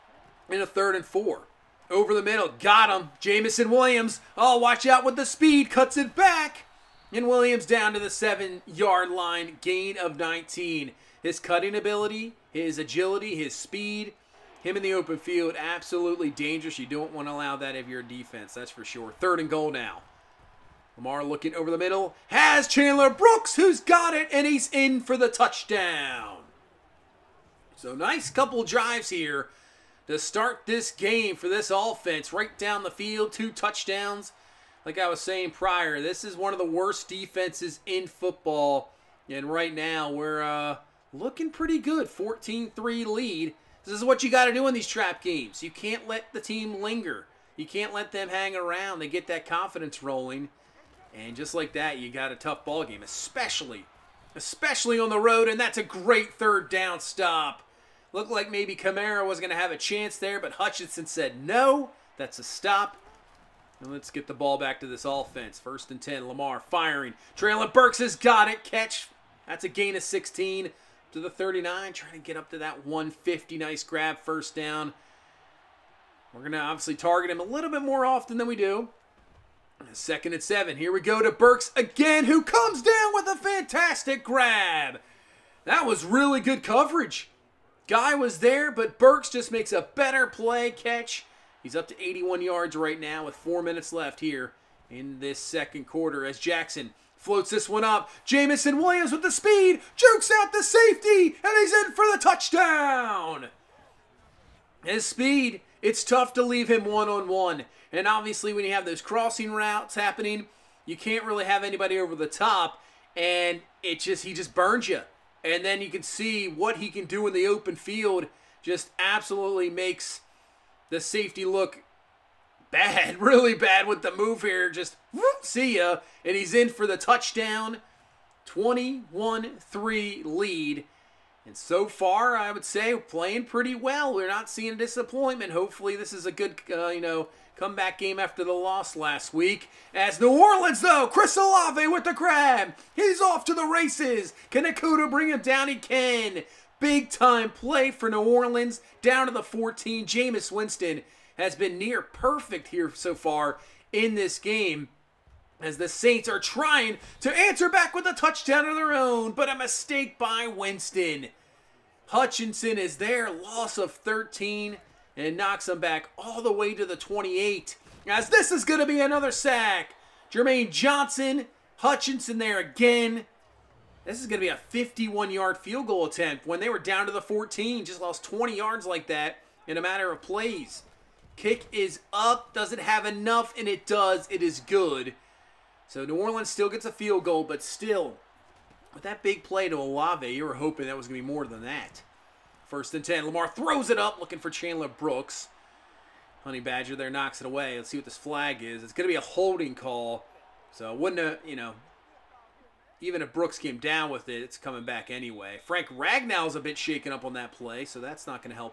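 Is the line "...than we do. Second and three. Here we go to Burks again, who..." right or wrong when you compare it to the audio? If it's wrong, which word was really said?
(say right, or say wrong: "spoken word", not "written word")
wrong: "seven", not "three".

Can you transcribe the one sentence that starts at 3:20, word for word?
So wouldn't have, you know, even if Brooks came down with it, it's coming back anyway.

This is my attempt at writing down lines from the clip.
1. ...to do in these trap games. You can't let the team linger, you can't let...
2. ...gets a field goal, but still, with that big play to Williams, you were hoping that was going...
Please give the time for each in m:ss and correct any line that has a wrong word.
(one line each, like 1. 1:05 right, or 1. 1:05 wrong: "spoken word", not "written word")
1. 0:44 right
2. 3:06 wrong: "Olave", not "Williams".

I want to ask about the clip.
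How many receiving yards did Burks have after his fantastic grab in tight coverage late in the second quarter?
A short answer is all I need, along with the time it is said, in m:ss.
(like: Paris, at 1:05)
81, at 1:32.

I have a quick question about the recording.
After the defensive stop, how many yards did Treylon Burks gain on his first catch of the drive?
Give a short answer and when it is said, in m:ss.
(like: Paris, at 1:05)
16, at 1:10.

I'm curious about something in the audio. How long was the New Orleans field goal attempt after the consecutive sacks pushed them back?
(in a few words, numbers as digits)
51 yards.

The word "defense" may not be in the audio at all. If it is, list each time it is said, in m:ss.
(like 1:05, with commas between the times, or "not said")
0:18, 0:37.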